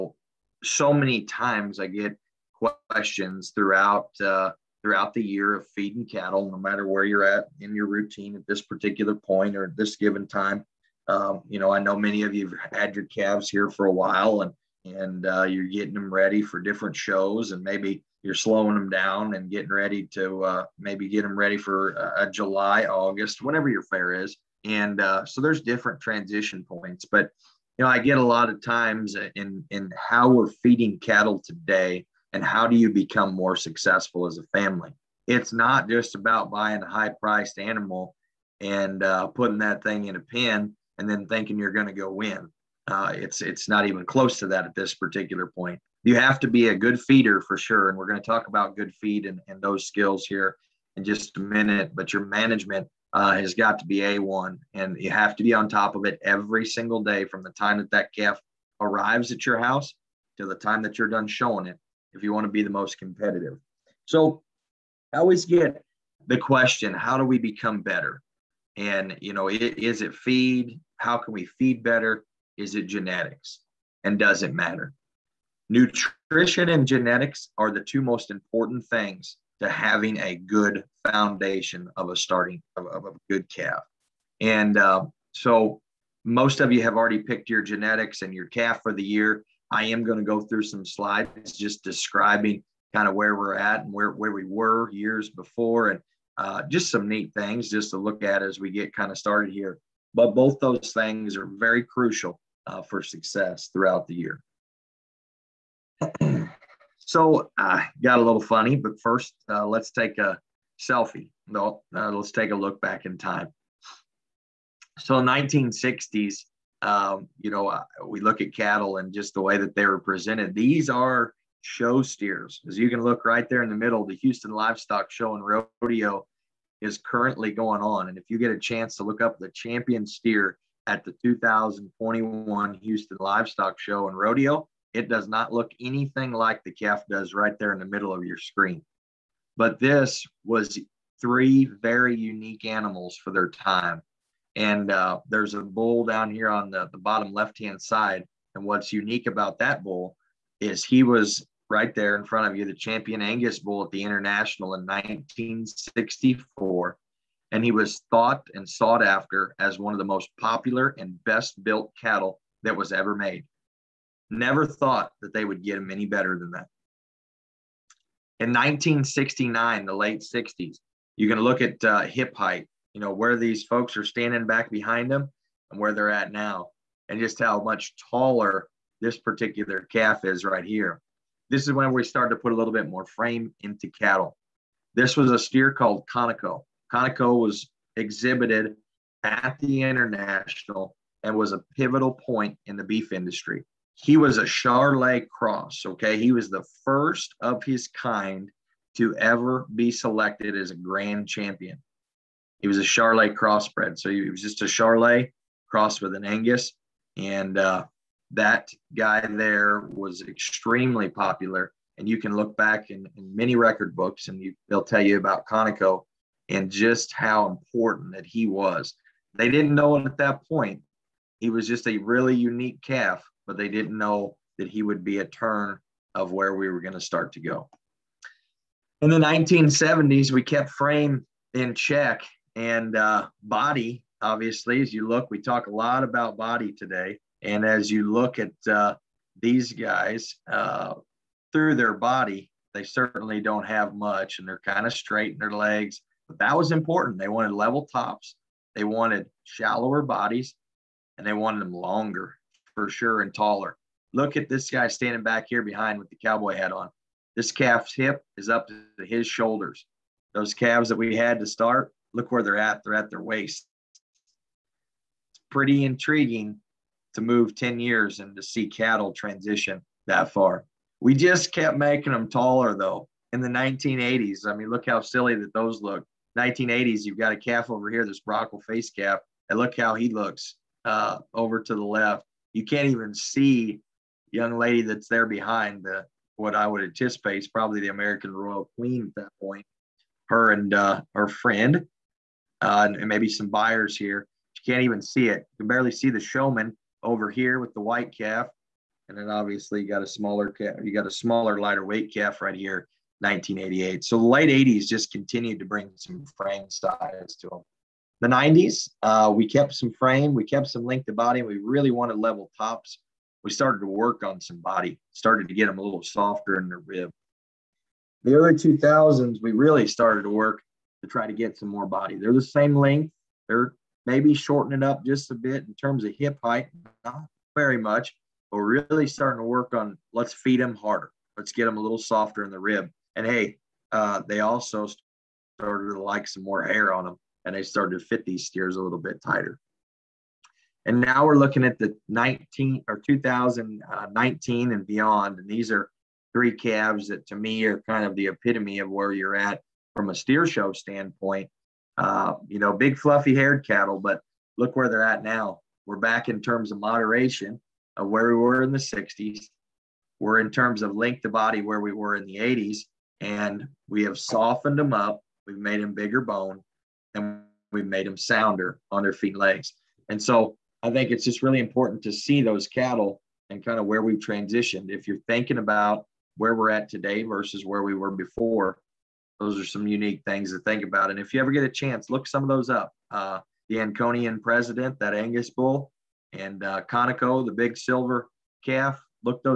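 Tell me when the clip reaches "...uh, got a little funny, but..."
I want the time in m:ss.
1:47.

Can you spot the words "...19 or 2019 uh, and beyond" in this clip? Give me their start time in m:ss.
5:42.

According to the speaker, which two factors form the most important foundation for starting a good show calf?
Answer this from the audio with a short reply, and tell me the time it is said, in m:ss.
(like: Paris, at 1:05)
Nutrition and genetics, at 1:15.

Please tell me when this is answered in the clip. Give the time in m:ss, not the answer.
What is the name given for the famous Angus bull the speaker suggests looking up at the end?
6:23.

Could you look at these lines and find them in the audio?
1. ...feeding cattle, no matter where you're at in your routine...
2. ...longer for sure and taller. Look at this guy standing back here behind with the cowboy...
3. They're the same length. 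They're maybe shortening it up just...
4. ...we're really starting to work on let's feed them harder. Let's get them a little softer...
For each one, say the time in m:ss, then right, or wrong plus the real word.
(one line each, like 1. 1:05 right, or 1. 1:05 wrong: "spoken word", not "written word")
1. 0:05 right
2. 4:11 right
3. 5:22 right
4. 5:28 right.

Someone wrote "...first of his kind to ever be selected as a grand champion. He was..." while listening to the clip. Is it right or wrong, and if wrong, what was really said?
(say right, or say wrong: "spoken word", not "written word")
right.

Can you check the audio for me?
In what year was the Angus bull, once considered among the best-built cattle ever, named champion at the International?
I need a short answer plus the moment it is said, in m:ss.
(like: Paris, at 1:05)
1964, at 2:34.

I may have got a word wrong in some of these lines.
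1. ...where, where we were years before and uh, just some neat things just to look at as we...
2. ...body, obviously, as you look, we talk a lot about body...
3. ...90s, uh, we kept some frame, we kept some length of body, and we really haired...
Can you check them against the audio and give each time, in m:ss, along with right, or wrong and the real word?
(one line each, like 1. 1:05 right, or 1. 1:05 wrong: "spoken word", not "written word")
1. 1:33 right
2. 3:53 right
3. 5:08 wrong: "wanted", not "haired".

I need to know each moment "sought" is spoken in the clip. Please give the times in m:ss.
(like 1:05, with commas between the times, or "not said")
2:38.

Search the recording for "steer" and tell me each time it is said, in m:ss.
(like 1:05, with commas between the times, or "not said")
2:02, 2:10, 3:05, 5:38, 5:50.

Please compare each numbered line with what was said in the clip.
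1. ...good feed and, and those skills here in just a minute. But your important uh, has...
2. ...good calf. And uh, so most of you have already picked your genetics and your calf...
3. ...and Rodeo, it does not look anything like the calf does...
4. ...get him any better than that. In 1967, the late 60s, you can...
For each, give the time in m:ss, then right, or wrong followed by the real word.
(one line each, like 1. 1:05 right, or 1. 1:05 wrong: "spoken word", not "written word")
1. 0:48 wrong: "management", not "important"
2. 1:23 right
3. 2:14 right
4. 2:45 wrong: "1969", not "1967".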